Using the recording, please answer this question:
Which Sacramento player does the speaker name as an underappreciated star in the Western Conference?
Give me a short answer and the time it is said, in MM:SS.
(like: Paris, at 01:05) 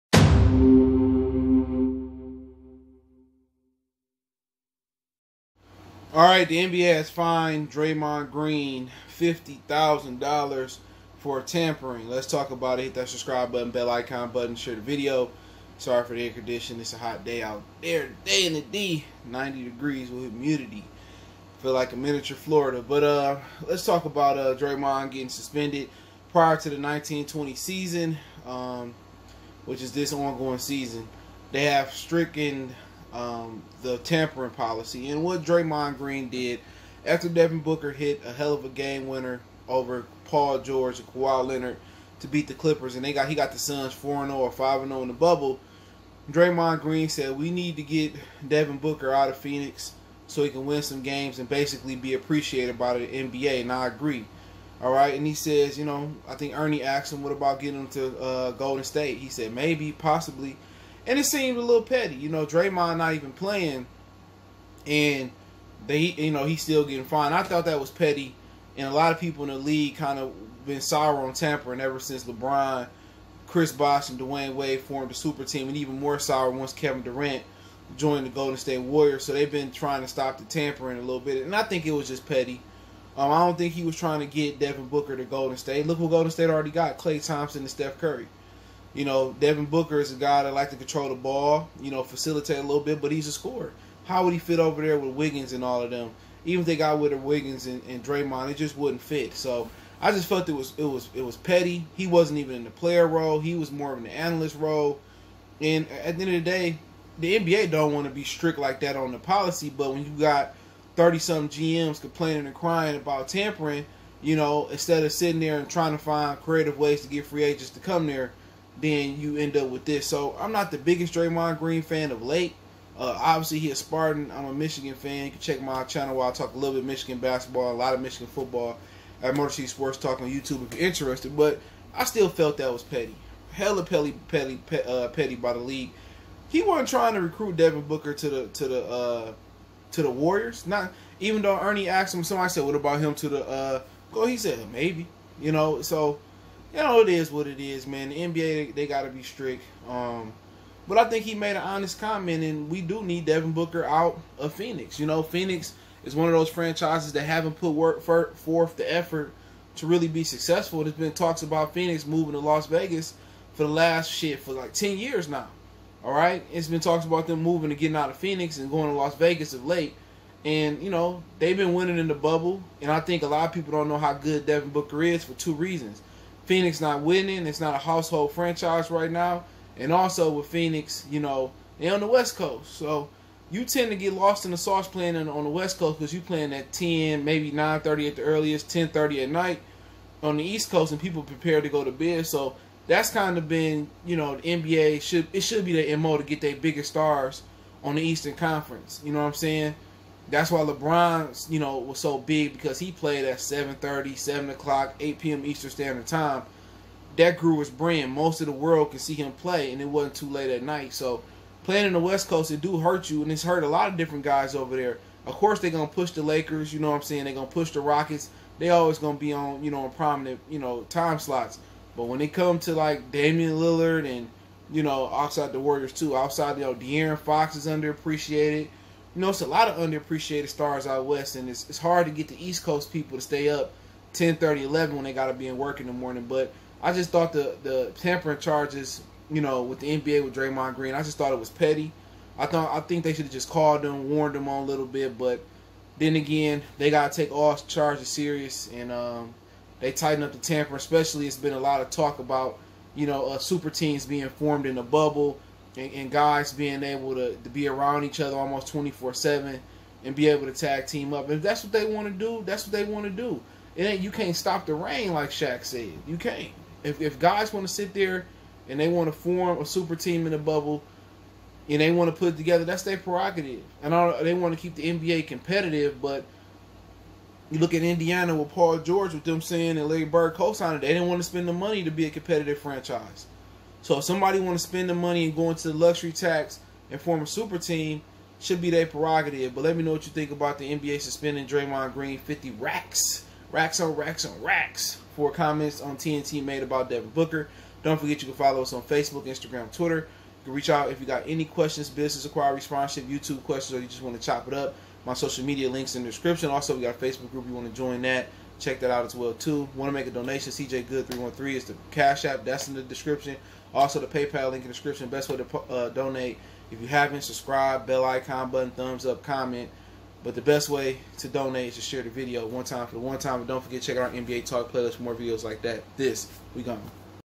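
De'Aaron Fox, at 03:46.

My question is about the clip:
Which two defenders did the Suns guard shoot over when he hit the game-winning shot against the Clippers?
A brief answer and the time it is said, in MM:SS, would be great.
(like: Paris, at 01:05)
Paul George and Kawhi Leonard, at 00:40.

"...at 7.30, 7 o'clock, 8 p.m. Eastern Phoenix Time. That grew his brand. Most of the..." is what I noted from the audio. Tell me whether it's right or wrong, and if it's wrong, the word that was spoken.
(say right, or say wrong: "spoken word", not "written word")
wrong: "Standard", not "Phoenix".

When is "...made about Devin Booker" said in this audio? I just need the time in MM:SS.
04:56.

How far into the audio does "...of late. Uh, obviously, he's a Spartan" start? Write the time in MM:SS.
02:02.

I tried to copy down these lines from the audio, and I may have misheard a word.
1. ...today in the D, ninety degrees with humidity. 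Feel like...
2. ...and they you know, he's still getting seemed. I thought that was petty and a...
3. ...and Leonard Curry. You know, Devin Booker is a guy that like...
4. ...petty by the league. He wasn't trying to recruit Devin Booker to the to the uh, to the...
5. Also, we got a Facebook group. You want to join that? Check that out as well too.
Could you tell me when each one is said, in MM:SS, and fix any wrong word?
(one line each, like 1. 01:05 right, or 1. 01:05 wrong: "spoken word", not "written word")
1. 00:18 right
2. 01:04 wrong: "fined", not "seemed"
3. 01:27 wrong: "Steph", not "Leonard"
4. 02:15 right
5. 05:06 right.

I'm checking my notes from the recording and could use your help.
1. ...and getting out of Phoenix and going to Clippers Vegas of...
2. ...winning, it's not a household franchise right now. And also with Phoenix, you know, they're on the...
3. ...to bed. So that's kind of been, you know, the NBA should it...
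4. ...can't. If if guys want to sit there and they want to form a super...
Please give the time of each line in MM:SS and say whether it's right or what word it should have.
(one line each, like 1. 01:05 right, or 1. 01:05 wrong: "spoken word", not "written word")
1. 02:47 wrong: "Las", not "Clippers"
2. 02:57 right
3. 03:11 right
4. 04:26 right.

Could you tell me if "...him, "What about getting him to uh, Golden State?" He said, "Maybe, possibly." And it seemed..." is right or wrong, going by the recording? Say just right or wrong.
right.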